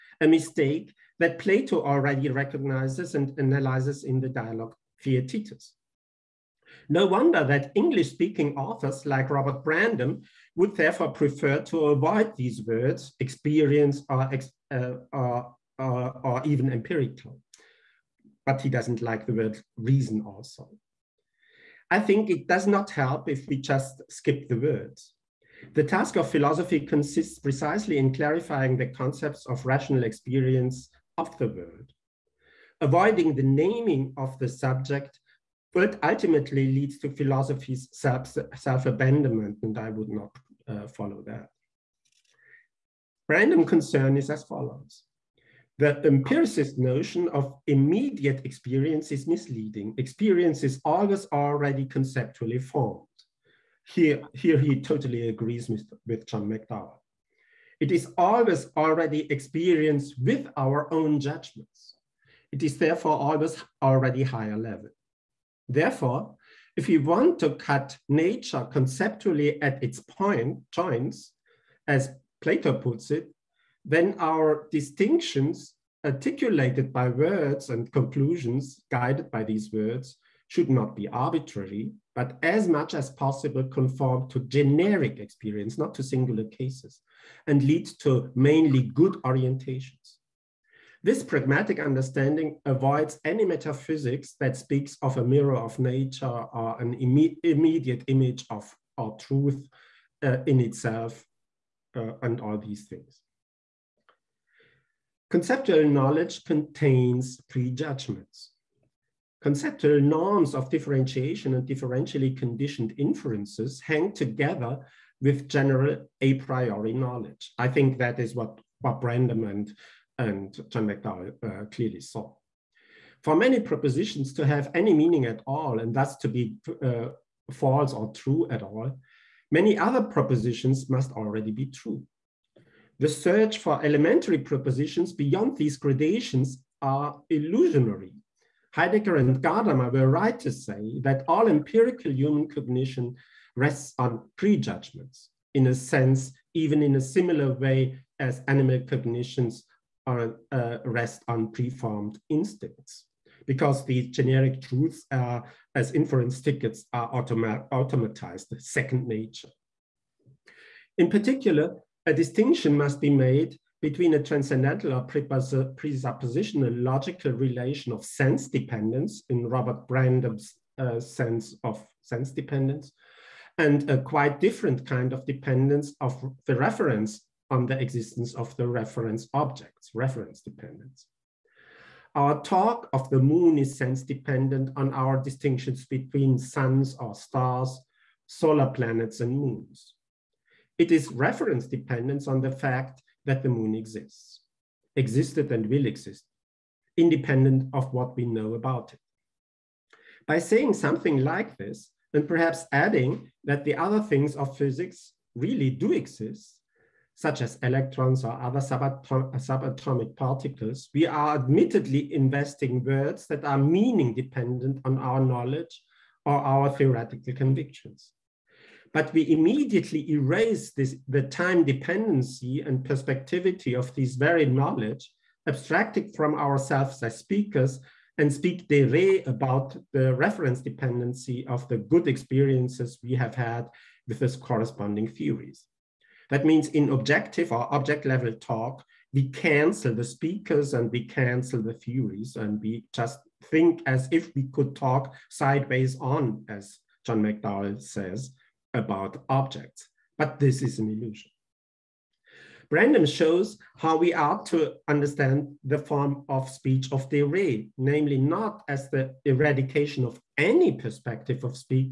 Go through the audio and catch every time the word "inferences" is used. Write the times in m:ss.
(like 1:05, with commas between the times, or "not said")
1:52, 2:35.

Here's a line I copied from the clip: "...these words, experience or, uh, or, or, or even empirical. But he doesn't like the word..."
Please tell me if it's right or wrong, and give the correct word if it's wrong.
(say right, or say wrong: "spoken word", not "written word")
right.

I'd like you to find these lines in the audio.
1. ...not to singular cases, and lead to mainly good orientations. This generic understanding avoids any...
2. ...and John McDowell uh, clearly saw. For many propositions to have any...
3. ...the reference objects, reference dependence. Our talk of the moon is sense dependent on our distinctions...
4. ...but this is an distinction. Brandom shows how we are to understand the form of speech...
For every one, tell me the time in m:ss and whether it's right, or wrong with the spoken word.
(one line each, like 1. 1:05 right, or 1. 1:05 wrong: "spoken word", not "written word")
1. 1:25 wrong: "pragmatic", not "generic"
2. 2:00 right
3. 2:58 right
4. 4:10 wrong: "illusion", not "distinction".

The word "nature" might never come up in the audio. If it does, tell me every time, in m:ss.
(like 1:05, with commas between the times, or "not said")
1:08, 1:35, 2:39.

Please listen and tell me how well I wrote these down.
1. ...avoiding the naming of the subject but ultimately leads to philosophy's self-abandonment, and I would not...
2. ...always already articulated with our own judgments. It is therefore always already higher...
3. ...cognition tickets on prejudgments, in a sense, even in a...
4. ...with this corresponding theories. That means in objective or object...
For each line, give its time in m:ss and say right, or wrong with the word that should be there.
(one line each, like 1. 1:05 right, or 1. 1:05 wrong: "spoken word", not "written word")
1. 0:32 right
2. 0:58 wrong: "experienced", not "articulated"
3. 2:22 wrong: "rests", not "tickets"
4. 3:54 right.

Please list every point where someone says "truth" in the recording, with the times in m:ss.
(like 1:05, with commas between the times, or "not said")
1:39, 2:34.